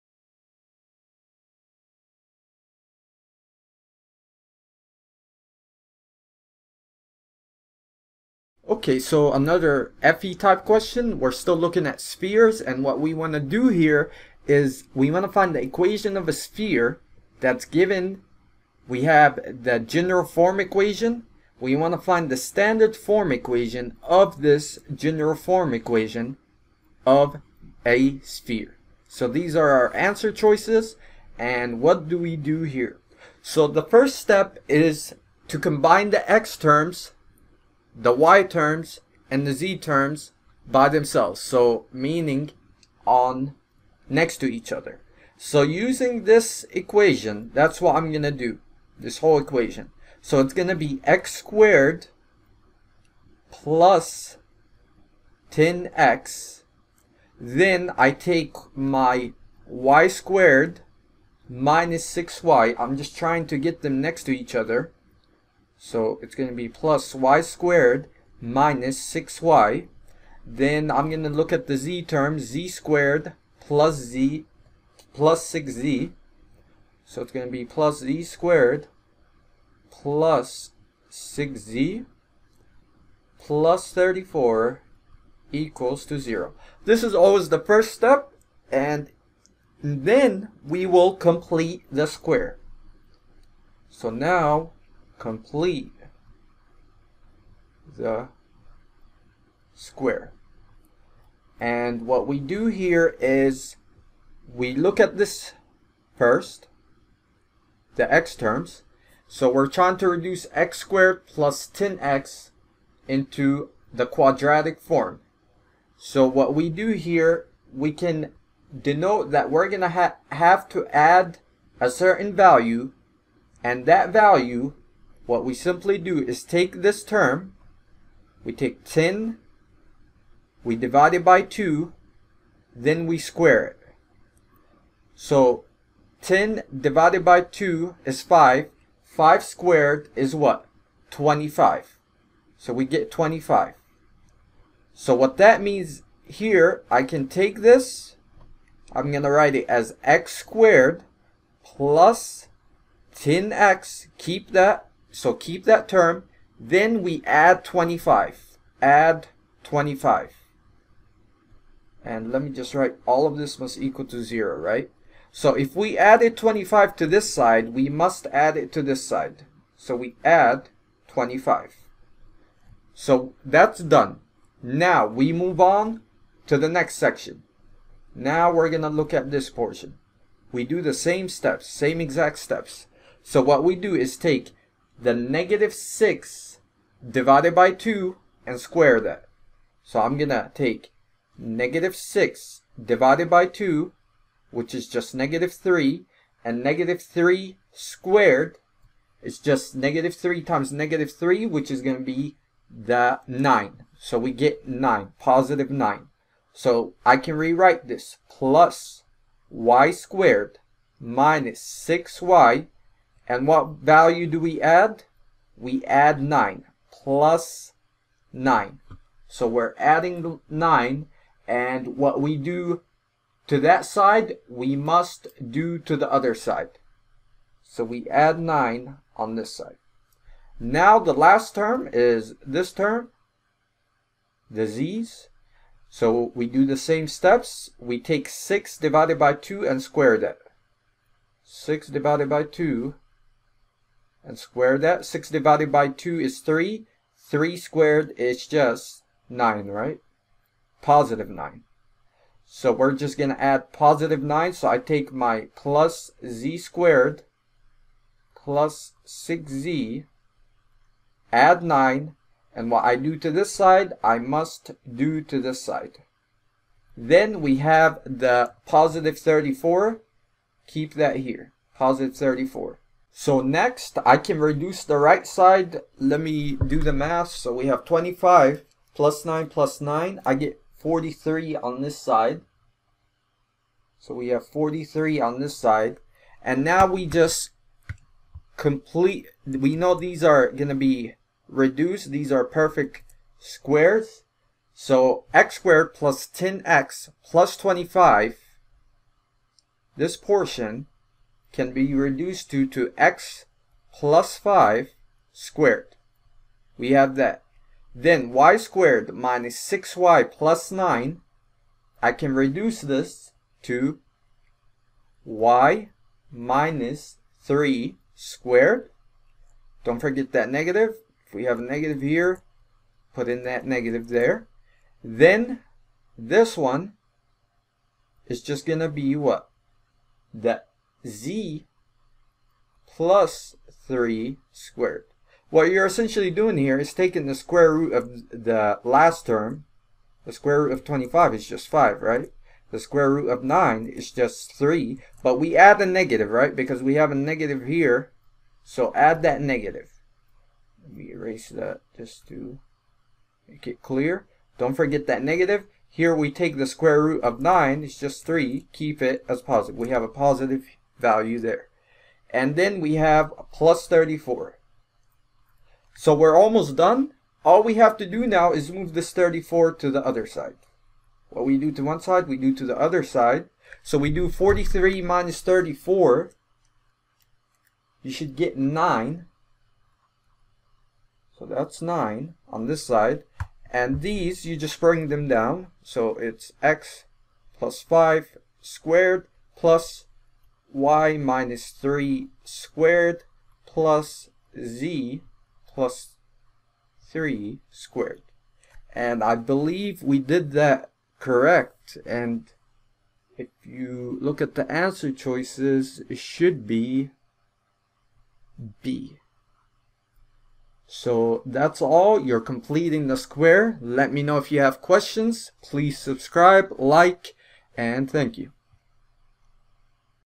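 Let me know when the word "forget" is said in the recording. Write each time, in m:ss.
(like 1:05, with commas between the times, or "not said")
5:19, 5:54.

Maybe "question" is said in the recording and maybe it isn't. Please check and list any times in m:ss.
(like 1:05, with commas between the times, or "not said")
0:10, 6:54.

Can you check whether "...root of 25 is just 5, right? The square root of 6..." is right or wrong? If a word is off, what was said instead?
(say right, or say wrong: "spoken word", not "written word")
wrong: "9", not "6".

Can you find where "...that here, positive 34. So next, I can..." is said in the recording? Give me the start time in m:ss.
4:30.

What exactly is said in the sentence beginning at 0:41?
So meaning on next to each other.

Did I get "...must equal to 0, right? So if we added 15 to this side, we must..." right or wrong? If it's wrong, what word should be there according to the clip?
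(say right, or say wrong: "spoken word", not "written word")
wrong: "25", not "15".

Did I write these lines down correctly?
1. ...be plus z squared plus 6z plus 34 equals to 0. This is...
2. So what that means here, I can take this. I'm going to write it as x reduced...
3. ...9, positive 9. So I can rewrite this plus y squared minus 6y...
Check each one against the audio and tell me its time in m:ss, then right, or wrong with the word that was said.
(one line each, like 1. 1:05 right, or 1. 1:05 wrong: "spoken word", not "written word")
1. 1:17 right
2. 2:24 wrong: "squared", not "reduced"
3. 3:24 right.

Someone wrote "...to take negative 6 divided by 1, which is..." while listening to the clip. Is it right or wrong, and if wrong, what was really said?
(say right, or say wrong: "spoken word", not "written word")
wrong: "2", not "1".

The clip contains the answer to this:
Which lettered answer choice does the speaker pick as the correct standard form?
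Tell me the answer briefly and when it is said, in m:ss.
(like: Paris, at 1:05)
B, at 6:48.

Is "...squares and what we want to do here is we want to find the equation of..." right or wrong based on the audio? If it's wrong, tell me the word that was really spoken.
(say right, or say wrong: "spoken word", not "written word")
wrong: "spheres", not "squares".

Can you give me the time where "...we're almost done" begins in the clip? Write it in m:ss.
6:06.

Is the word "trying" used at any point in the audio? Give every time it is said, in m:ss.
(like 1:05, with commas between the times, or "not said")
1:03, 1:49.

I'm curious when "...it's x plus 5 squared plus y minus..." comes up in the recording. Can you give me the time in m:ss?
6:26.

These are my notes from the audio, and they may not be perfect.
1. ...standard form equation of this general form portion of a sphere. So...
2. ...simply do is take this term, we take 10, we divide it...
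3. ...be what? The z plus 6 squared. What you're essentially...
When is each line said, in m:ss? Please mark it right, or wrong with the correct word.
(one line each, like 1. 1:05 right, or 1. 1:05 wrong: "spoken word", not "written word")
1. 0:22 wrong: "equation", not "portion"
2. 2:05 right
3. 5:28 wrong: "3", not "6".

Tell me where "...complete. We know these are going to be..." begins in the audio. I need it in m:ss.
4:48.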